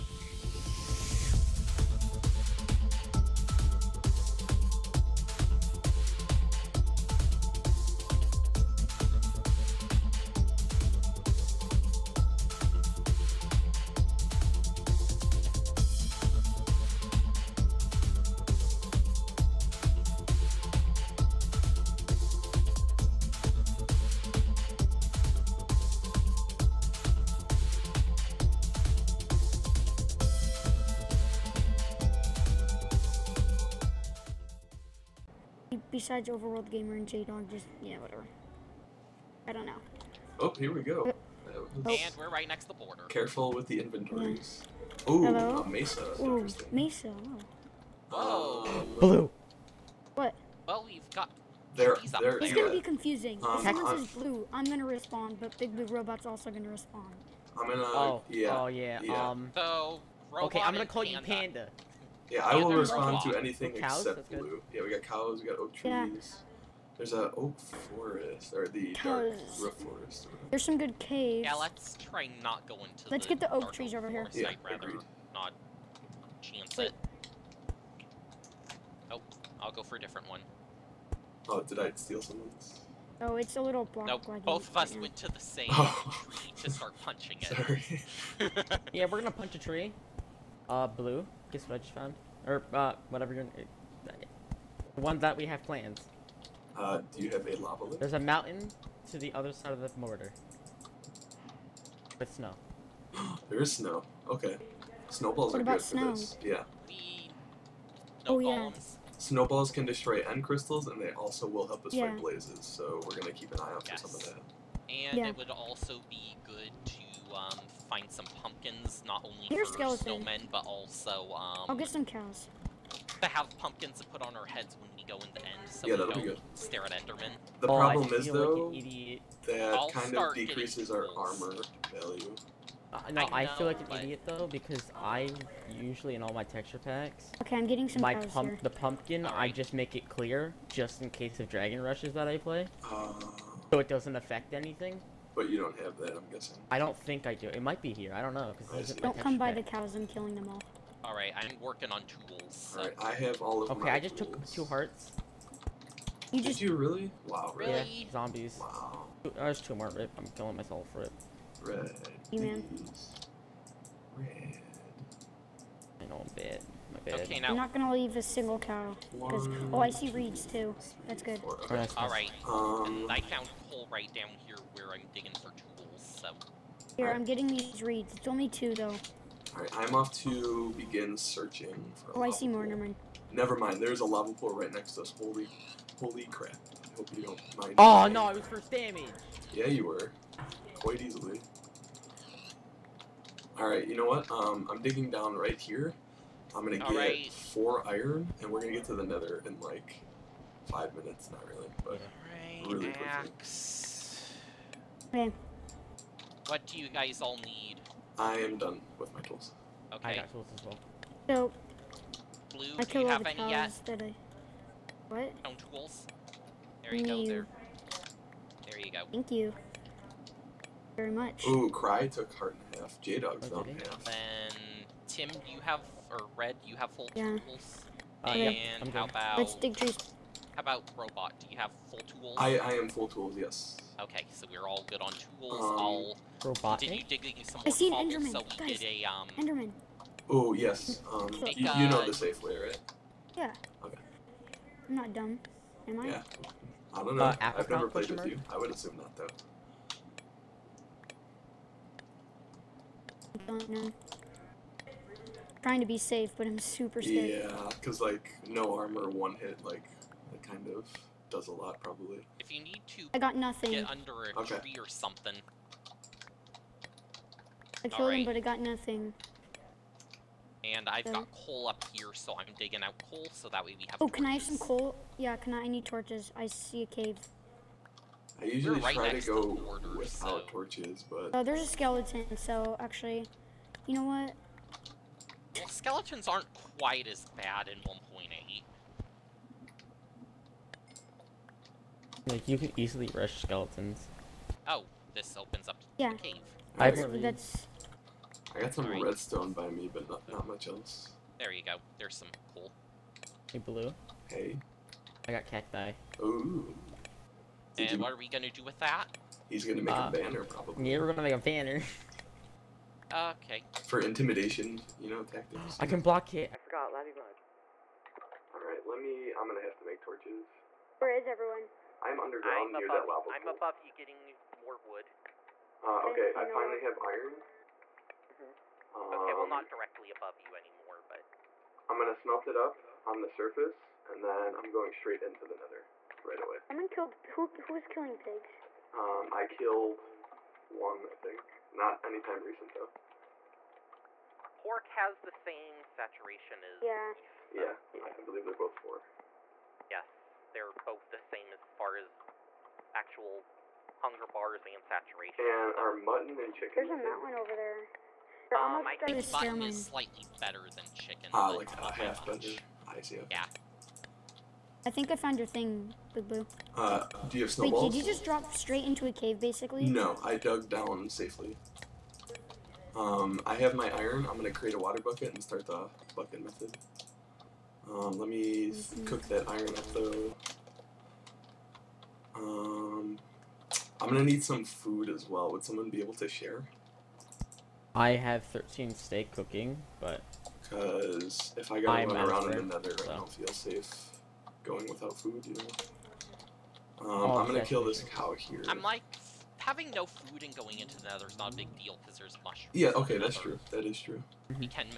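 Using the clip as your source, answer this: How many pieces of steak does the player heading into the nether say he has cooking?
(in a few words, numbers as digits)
13.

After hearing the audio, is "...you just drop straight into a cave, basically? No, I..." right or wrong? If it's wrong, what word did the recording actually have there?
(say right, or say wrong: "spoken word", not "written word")
right.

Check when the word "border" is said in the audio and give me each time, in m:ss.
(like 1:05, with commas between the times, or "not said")
0:42, 4:39.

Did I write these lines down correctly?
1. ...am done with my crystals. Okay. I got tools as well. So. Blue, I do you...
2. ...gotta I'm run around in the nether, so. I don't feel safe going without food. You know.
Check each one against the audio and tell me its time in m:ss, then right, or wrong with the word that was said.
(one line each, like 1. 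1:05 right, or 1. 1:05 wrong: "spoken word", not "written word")
1. 3:28 wrong: "tools", not "crystals"
2. 6:31 right.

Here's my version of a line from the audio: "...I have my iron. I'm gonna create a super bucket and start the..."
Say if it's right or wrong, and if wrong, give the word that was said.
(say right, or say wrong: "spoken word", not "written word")
wrong: "water", not "super".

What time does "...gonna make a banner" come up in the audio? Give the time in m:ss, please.
5:11.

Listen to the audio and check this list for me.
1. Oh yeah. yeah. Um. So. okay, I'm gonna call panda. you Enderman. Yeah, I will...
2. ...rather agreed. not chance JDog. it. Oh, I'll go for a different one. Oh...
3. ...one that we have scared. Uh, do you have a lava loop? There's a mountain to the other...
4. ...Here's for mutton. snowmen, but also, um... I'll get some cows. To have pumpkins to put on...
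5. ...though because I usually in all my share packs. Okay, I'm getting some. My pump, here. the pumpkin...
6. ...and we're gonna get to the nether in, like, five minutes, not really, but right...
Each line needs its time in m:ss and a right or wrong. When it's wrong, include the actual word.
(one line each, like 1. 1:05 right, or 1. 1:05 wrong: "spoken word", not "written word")
1. 0:58 wrong: "Panda", not "Enderman"
2. 1:14 wrong: "Wait", not "JDog"
3. 1:34 wrong: "planned", not "scared"
4. 1:59 wrong: "skeleton", not "mutton"
5. 2:14 wrong: "texture", not "share"
6. 3:18 right.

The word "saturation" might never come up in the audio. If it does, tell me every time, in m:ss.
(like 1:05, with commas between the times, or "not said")
5:45, 5:54.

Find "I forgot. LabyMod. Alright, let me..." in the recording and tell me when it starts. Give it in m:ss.
5:16.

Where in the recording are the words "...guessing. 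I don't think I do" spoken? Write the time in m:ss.
2:26.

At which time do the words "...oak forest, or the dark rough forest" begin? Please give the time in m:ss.
1:07.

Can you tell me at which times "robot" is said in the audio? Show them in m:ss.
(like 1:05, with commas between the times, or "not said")
0:55, 3:50, 3:56.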